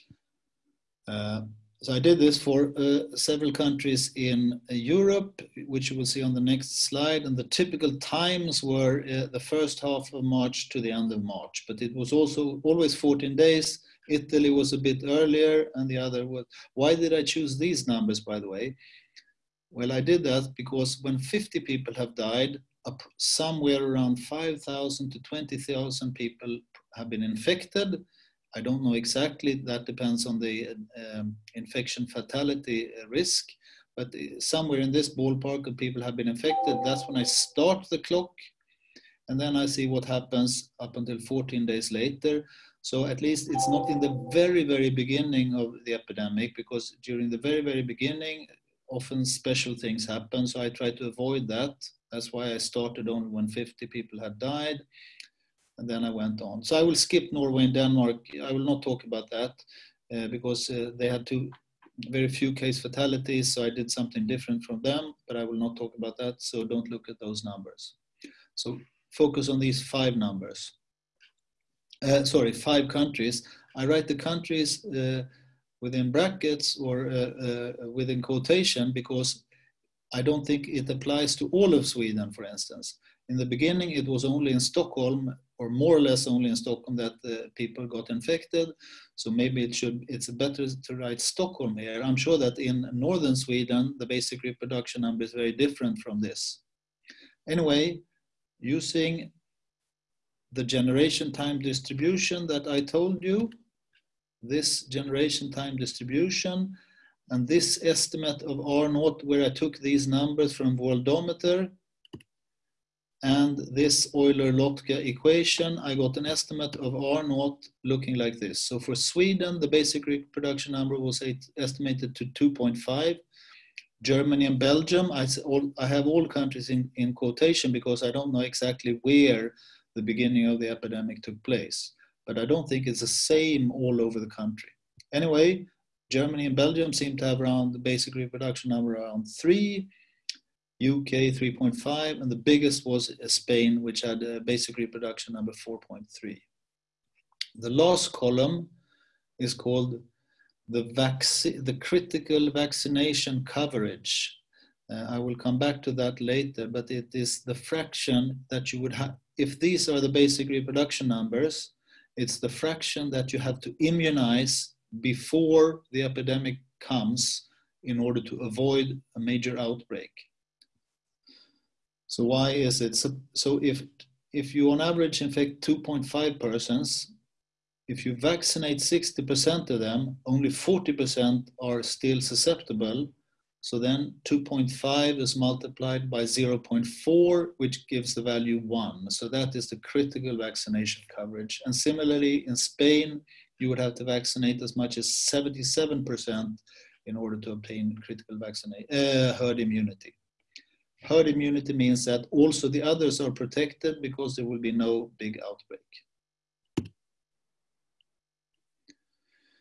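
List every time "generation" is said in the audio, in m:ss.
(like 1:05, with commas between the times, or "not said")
1:40, 1:44.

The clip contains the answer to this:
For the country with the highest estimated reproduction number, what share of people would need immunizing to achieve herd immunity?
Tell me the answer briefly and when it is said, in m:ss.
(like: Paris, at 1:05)
77%, at 3:15.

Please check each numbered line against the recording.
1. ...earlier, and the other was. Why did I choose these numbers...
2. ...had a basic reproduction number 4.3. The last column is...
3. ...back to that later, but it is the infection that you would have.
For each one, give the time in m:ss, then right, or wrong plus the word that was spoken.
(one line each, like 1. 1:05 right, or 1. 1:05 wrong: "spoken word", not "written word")
1. 0:15 right
2. 2:24 right
3. 2:35 wrong: "fraction", not "infection".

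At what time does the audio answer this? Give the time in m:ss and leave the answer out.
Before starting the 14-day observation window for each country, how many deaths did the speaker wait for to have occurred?
0:21.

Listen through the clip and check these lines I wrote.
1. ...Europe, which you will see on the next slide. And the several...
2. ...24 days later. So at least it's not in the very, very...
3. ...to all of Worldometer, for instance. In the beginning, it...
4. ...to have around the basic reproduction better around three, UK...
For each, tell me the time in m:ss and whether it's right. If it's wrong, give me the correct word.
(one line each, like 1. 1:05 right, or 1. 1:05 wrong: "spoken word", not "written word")
1. 0:04 wrong: "typical", not "several"
2. 0:41 wrong: "14", not "24"
3. 1:21 wrong: "Sweden", not "Worldometer"
4. 2:17 wrong: "number", not "better".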